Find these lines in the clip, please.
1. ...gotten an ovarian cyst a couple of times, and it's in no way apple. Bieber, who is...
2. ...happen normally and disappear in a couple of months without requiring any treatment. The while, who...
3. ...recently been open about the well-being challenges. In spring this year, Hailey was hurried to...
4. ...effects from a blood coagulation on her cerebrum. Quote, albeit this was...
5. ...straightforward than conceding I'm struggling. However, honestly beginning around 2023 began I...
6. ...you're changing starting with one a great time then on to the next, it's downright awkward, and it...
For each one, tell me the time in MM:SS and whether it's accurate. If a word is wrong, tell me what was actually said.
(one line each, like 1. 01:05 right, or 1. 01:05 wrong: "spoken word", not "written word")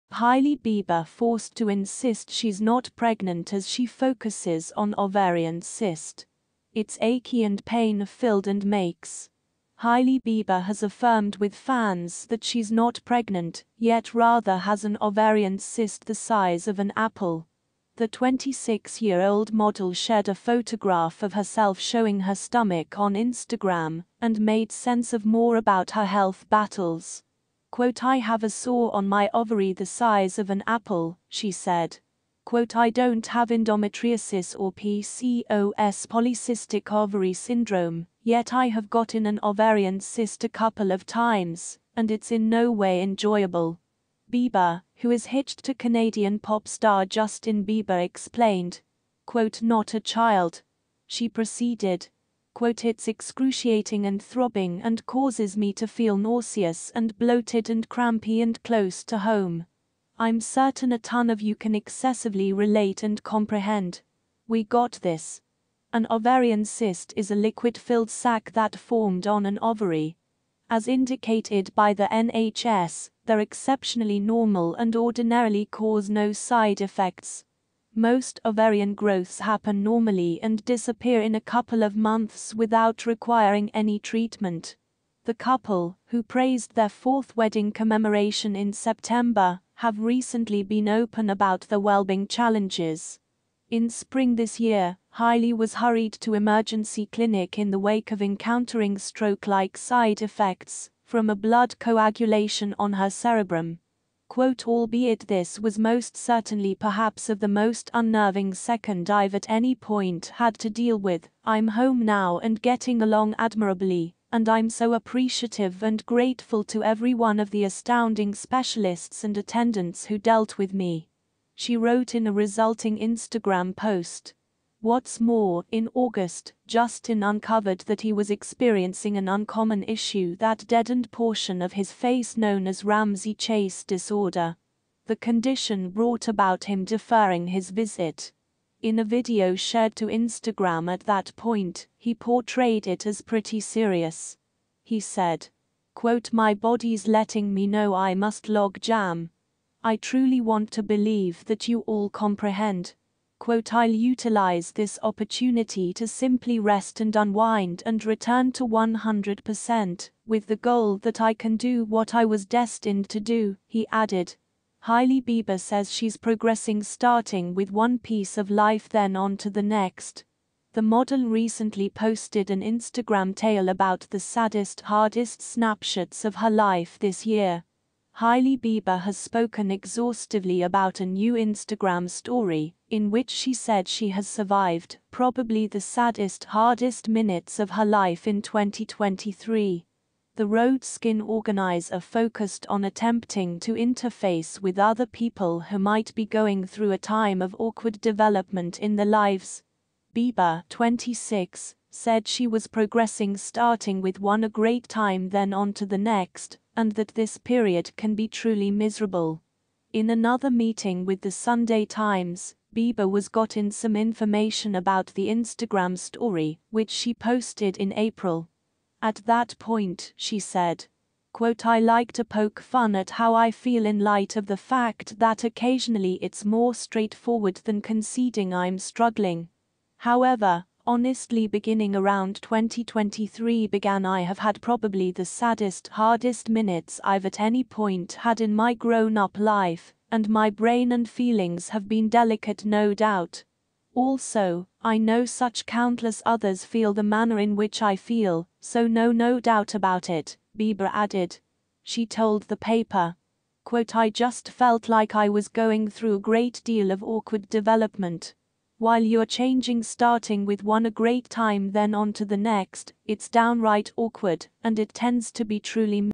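1. 00:38 wrong: "enjoyable", not "apple"
2. 01:19 wrong: "couple", not "while"
3. 01:29 right
4. 01:40 right
5. 03:46 right
6. 04:19 right.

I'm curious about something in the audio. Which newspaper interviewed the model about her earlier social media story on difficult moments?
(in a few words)
Sunday Times.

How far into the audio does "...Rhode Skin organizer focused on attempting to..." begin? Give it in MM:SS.
03:10.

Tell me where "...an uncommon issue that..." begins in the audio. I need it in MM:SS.
02:09.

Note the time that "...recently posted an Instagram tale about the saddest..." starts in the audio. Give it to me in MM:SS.
02:51.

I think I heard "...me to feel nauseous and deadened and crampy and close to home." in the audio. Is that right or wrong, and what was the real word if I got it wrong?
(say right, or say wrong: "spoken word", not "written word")
wrong: "bloated", not "deadened".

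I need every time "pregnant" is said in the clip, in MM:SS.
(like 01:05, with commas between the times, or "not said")
00:02, 00:13.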